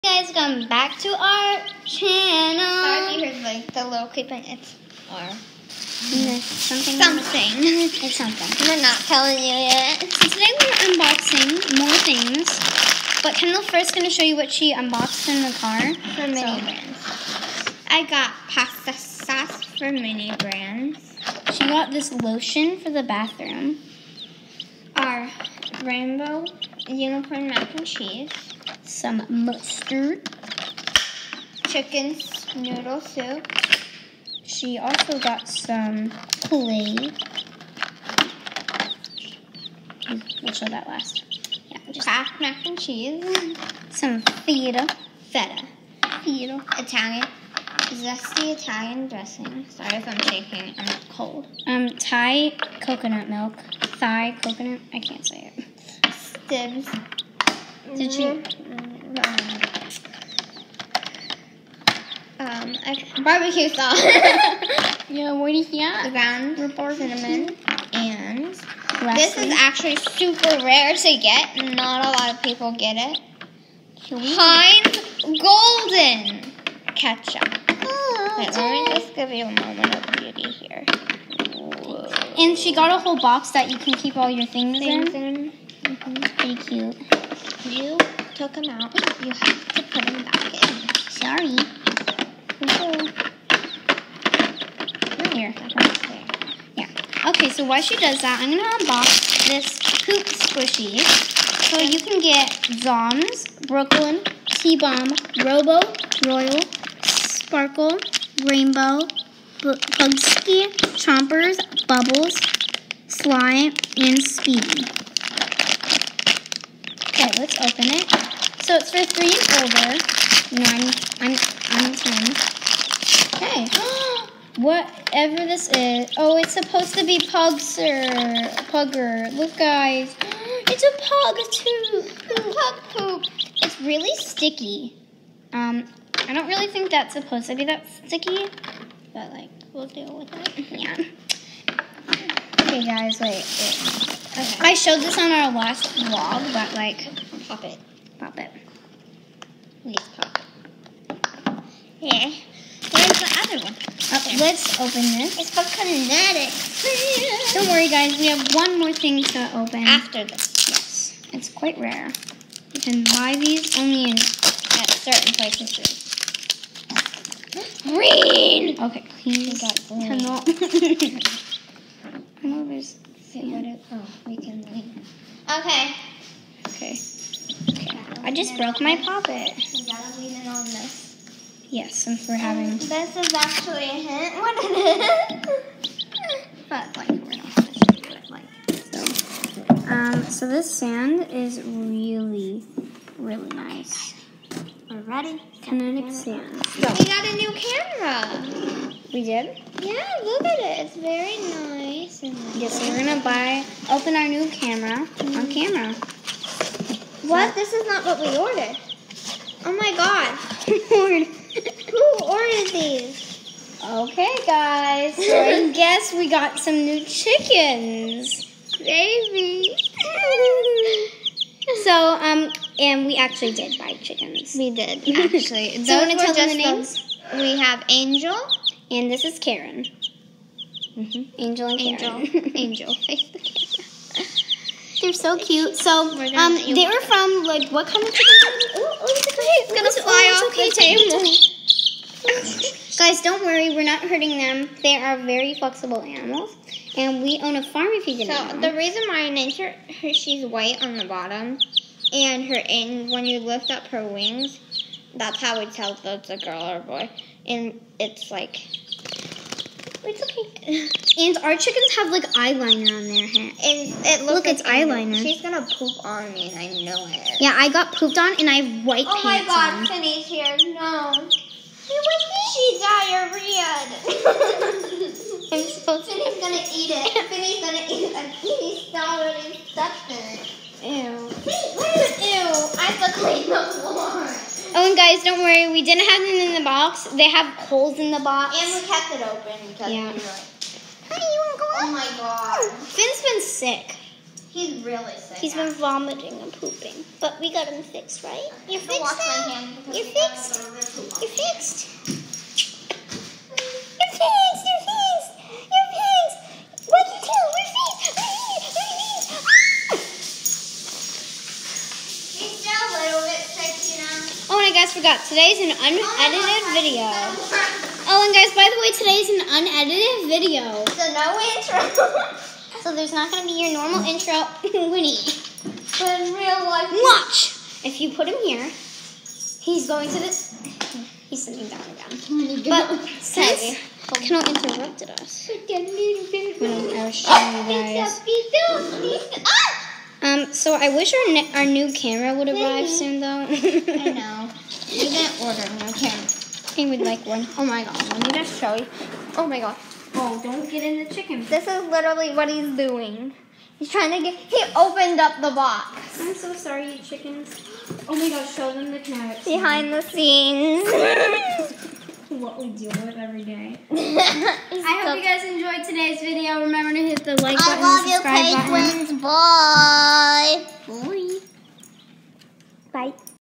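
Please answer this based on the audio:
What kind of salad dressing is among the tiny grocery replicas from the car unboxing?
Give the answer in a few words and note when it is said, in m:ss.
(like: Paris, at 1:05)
Zesty Italian, at 0:47.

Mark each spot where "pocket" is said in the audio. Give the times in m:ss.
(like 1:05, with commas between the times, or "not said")
2:58.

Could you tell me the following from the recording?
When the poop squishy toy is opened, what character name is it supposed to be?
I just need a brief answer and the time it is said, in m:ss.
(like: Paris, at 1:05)
Pugser, at 2:07.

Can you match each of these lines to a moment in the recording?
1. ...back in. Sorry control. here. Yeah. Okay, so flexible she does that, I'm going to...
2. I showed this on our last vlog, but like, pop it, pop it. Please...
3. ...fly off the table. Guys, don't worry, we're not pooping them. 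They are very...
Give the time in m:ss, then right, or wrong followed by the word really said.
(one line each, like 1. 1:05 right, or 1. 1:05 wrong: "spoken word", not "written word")
1. 1:30 wrong: "while", not "flexible"
2. 2:24 right
3. 3:59 wrong: "hurting", not "pooping".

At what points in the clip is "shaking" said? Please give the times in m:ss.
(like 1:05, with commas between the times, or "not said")
0:50.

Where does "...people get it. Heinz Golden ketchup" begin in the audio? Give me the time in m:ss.
1:12.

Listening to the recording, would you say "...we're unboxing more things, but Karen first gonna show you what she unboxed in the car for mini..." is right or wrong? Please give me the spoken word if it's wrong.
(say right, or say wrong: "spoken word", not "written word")
wrong: "Kendall", not "Karen".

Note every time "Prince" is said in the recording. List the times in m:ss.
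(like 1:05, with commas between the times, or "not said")
not said.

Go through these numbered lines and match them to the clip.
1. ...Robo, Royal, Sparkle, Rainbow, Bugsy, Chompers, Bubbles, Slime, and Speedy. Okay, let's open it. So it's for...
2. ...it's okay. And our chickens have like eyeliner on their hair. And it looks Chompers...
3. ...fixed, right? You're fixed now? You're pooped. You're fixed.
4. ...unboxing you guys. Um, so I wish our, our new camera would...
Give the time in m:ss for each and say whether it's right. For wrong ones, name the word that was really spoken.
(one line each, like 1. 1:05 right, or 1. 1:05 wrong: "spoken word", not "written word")
1. 1:45 right
2. 4:20 wrong: "Look", not "Chompers"
3. 4:57 wrong: "fixed", not "pooped"
4. 5:37 wrong: "showing", not "unboxing".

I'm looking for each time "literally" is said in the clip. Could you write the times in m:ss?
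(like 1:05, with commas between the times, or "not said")
5:51.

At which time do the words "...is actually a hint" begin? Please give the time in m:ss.
3:03.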